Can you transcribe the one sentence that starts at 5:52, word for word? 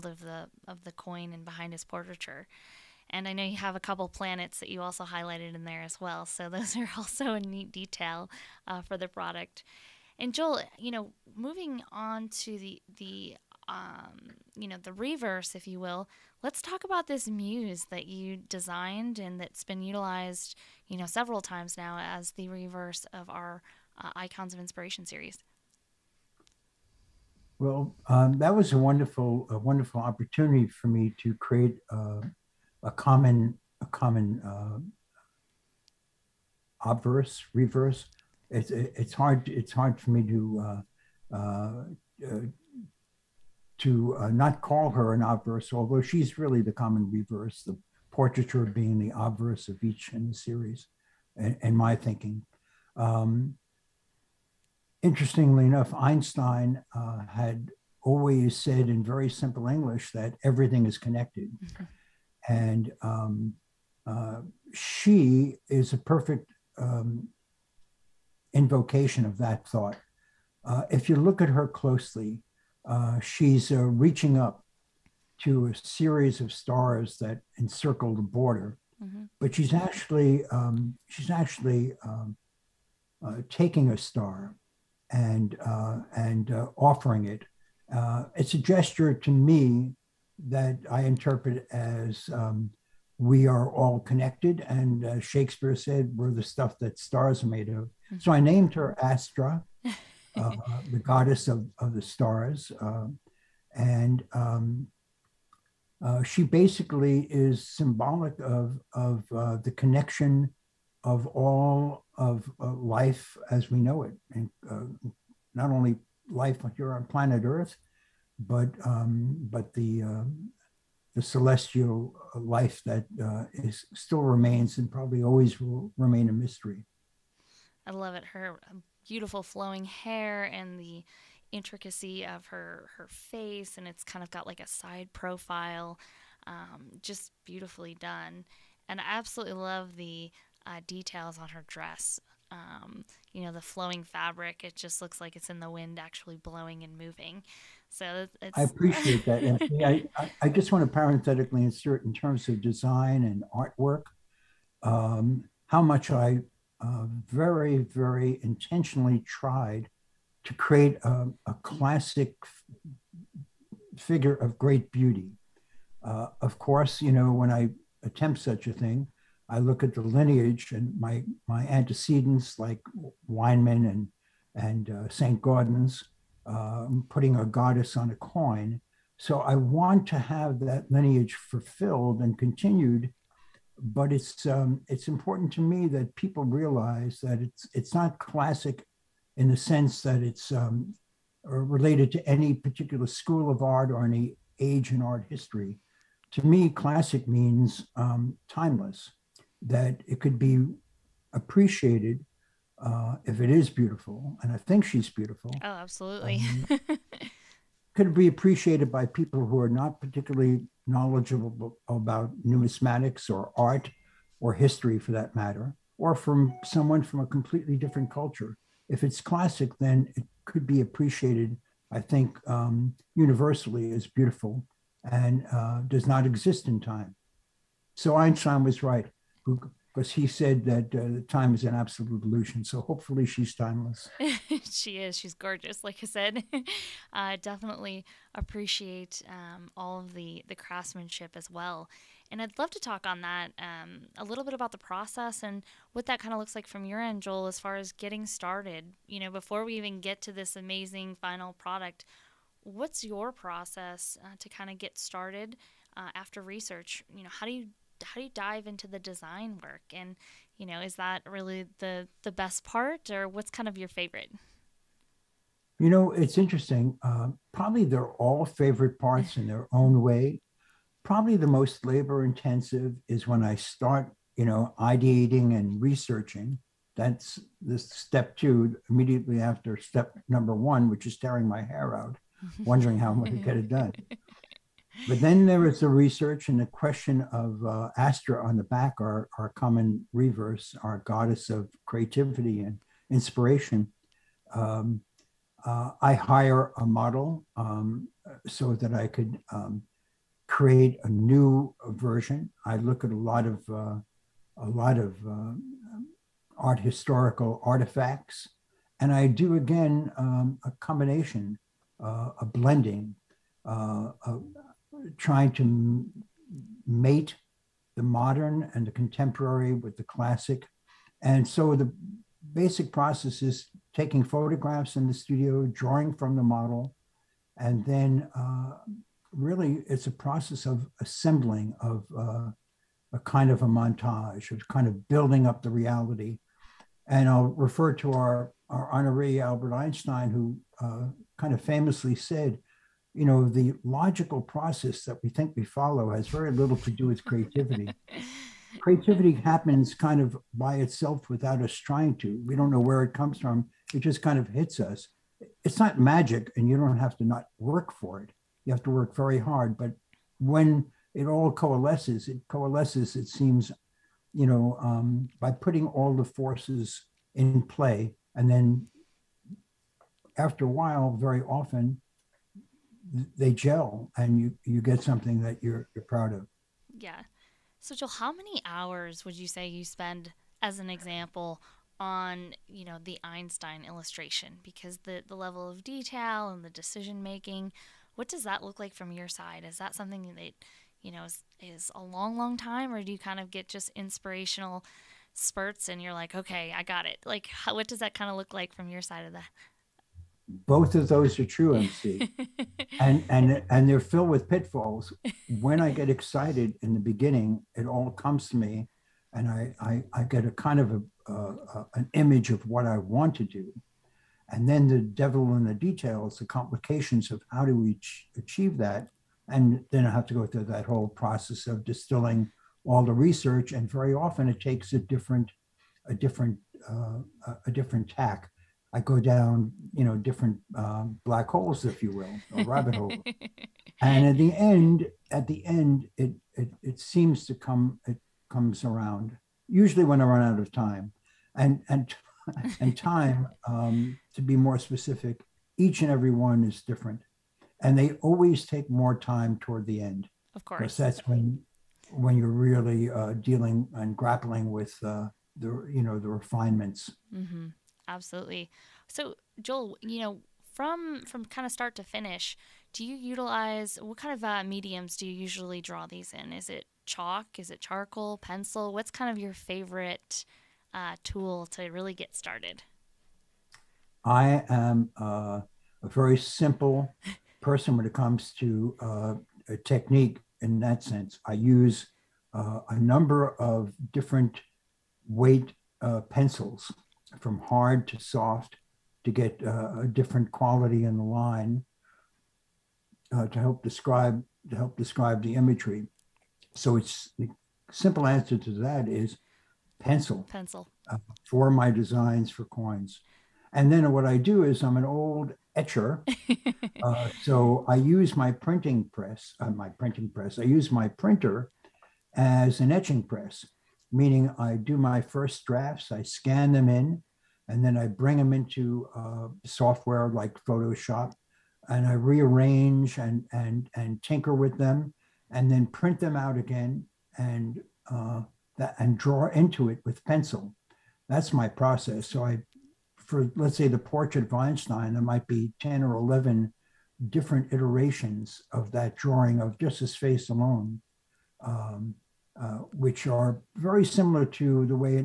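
We don't know where it comes from.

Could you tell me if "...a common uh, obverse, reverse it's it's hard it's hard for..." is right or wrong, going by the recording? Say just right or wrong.
right.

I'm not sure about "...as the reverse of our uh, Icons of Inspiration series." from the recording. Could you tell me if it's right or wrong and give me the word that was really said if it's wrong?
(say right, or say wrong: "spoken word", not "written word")
right.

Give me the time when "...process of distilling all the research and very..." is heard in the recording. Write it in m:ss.
7:01.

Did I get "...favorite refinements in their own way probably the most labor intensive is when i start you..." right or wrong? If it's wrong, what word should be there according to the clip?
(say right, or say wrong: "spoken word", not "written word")
wrong: "parts", not "refinements".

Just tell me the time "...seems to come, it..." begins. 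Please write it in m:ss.
7:16.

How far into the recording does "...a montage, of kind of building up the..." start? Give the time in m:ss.
5:33.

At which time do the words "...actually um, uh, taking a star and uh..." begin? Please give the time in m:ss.
1:21.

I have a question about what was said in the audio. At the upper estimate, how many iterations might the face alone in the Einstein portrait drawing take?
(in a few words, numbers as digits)
11.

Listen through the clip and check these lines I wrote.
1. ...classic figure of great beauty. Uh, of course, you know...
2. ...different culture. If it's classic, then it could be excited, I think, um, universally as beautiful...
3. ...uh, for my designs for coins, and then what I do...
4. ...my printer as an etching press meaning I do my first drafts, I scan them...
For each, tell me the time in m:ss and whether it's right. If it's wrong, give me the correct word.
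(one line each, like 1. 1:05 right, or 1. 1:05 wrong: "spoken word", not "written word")
1. 2:41 right
2. 3:37 wrong: "appreciated", not "excited"
3. 8:21 right
4. 8:30 right.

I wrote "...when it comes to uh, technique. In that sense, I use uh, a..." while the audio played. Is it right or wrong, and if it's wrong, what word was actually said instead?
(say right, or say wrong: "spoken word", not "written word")
right.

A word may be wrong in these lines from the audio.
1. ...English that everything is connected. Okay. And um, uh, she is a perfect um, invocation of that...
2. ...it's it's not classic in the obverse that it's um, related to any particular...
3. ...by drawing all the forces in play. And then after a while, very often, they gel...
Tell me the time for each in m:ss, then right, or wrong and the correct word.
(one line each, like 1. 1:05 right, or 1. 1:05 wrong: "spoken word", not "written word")
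1. 0:59 right
2. 3:07 wrong: "sense", not "obverse"
3. 6:05 wrong: "putting", not "drawing".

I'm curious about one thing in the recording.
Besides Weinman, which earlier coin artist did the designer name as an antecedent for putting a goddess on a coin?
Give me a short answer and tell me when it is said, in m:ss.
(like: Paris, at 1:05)
St. Gaudens, at 2:55.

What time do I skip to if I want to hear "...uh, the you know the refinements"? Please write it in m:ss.
7:35.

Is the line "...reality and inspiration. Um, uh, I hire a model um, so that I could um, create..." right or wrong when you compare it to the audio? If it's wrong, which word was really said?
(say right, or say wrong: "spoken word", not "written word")
wrong: "creativity", not "reality".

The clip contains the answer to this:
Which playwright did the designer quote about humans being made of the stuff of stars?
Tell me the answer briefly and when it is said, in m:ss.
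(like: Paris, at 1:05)
Shakespeare, at 1:35.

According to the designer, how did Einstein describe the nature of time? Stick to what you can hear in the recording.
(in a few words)
an absolute illusion.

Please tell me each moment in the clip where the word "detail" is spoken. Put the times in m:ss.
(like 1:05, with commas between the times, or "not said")
0:07, 2:20, 6:25, 6:55.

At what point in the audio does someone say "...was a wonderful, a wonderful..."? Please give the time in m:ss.
0:28.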